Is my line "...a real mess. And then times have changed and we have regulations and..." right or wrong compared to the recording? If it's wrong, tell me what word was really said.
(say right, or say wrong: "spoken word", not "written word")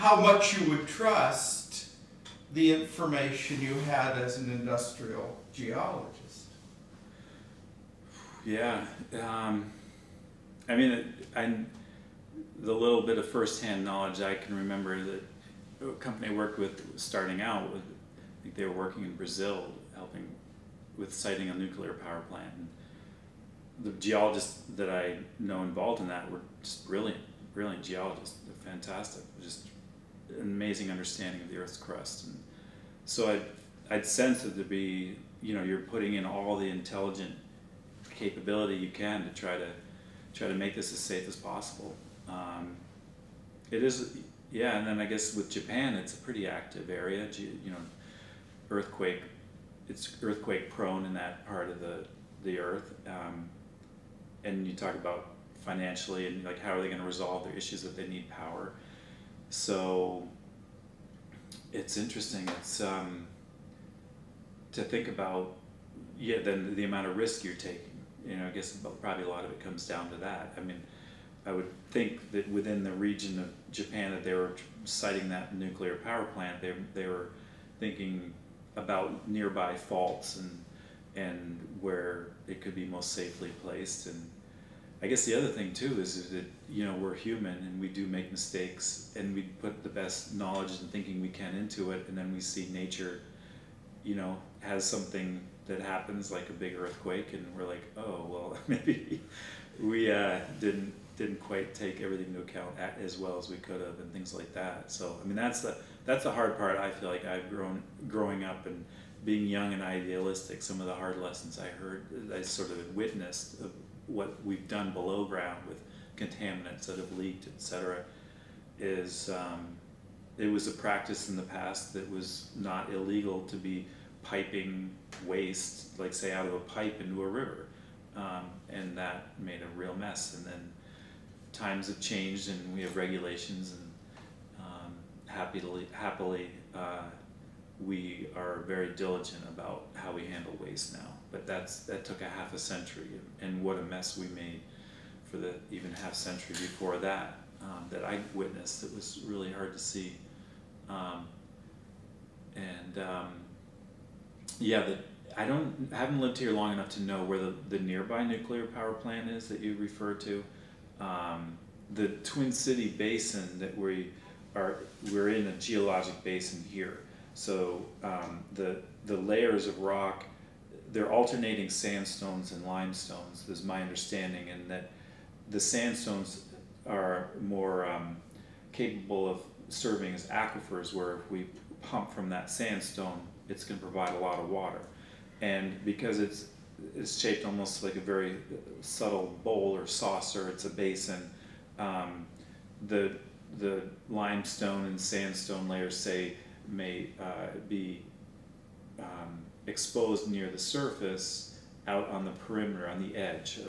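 right.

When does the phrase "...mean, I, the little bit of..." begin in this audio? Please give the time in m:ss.
0:10.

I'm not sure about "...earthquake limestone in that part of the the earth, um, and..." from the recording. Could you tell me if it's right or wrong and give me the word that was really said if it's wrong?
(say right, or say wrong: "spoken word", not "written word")
wrong: "prone", not "limestone".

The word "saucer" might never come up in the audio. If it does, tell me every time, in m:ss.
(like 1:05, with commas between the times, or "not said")
3:09.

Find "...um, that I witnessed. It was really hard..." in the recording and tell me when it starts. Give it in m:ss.
2:27.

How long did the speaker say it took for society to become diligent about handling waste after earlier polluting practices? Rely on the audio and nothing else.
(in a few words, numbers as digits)
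half a century.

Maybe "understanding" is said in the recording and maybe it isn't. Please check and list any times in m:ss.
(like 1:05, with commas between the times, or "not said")
0:30, 2:53.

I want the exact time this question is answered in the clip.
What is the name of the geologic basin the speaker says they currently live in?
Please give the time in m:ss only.
2:42.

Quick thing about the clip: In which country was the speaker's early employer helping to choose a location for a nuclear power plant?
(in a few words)
Brazil.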